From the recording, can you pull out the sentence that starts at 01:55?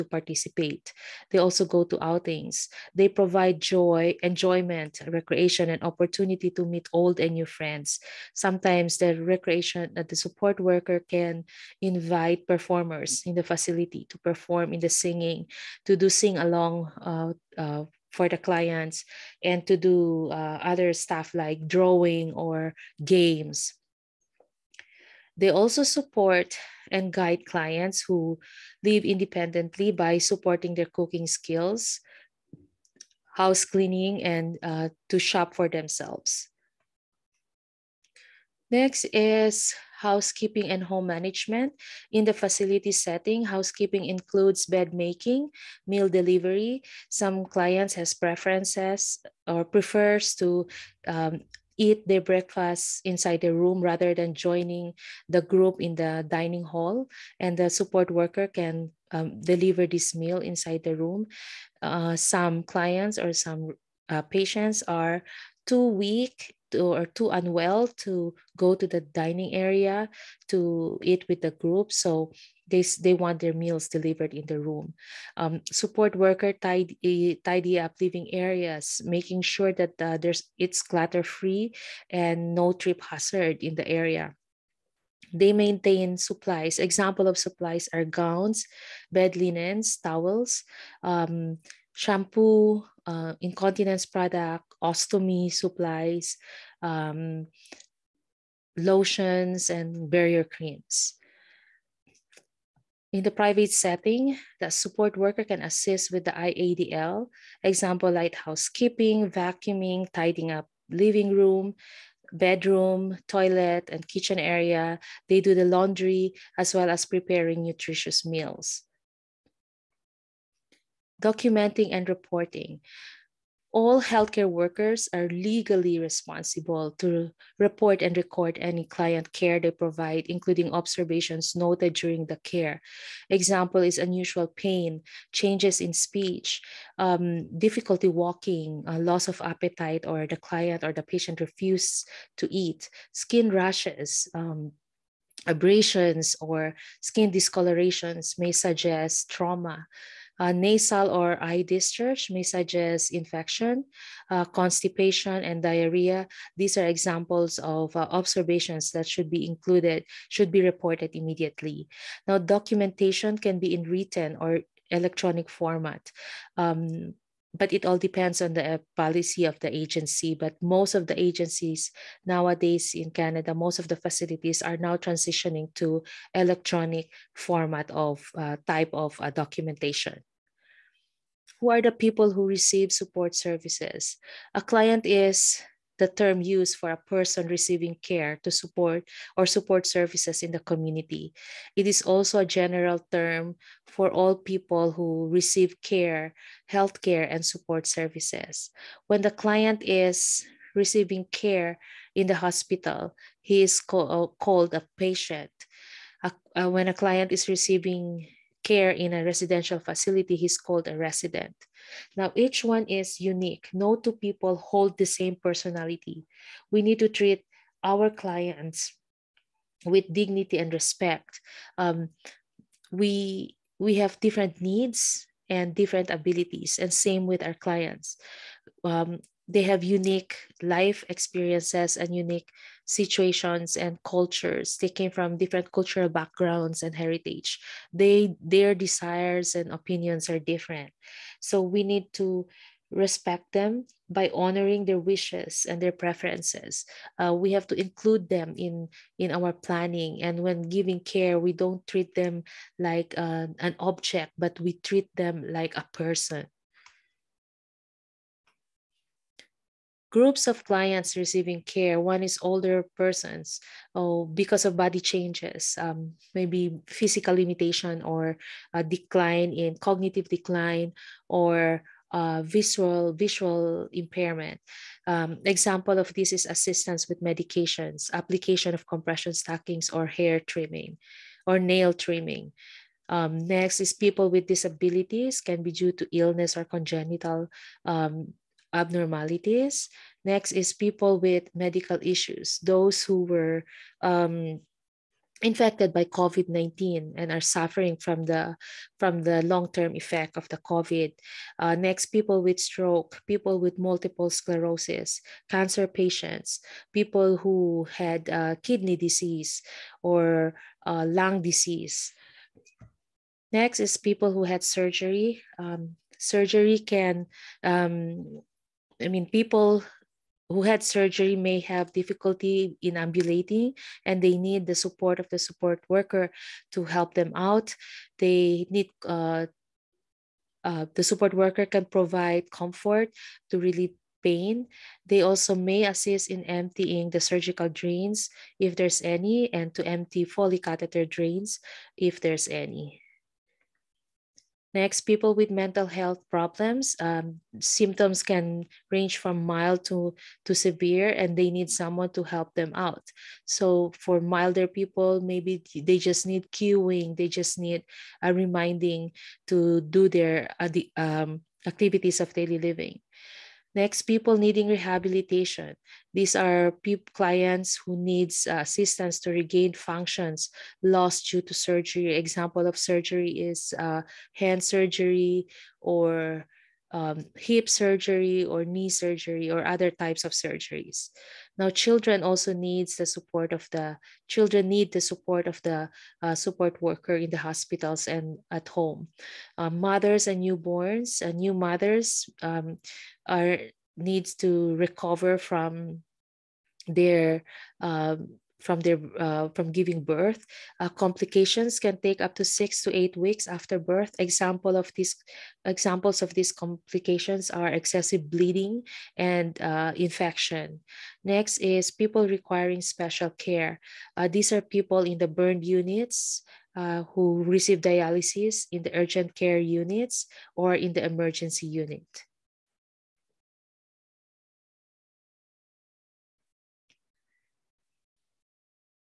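They do the laundry as well as preparing nutritious meals.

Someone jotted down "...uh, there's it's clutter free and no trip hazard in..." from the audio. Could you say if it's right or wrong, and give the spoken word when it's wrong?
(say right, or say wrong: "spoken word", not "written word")
right.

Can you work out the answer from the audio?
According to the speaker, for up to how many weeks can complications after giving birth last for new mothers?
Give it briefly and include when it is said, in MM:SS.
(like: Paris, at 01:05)
6 to 8 weeks, at 06:42.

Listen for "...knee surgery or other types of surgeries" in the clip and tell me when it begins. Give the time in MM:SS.
06:18.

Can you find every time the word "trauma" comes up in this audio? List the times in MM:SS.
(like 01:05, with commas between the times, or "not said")
02:29.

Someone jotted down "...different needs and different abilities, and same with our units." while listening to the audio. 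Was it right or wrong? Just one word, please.
wrong.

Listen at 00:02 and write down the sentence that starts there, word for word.
They provide joy, enjoyment, recreation, and opportunity to meet old and new friends.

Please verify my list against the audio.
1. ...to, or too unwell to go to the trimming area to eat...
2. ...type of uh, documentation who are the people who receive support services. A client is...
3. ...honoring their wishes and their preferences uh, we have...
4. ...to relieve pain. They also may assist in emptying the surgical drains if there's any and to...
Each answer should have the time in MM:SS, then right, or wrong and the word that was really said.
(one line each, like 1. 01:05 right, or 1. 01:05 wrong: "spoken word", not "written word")
1. 01:06 wrong: "dining", not "trimming"
2. 02:58 right
3. 04:04 right
4. 05:33 right.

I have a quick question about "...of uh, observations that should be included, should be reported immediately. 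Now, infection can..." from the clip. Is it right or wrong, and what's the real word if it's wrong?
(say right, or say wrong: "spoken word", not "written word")
wrong: "documentation", not "infection".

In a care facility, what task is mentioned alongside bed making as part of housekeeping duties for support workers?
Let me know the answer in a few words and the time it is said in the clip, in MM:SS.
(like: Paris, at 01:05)
Meal delivery, at 00:45.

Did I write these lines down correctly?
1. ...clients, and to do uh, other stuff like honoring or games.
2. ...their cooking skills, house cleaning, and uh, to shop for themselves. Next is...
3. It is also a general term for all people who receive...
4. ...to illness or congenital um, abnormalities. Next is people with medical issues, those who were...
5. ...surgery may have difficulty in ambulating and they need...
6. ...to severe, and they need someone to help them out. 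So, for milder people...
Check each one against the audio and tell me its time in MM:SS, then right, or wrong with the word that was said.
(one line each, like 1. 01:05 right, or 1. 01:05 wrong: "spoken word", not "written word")
1. 00:18 wrong: "drawing", not "honoring"
2. 00:30 right
3. 03:11 right
4. 04:45 right
5. 05:20 right
6. 05:50 right.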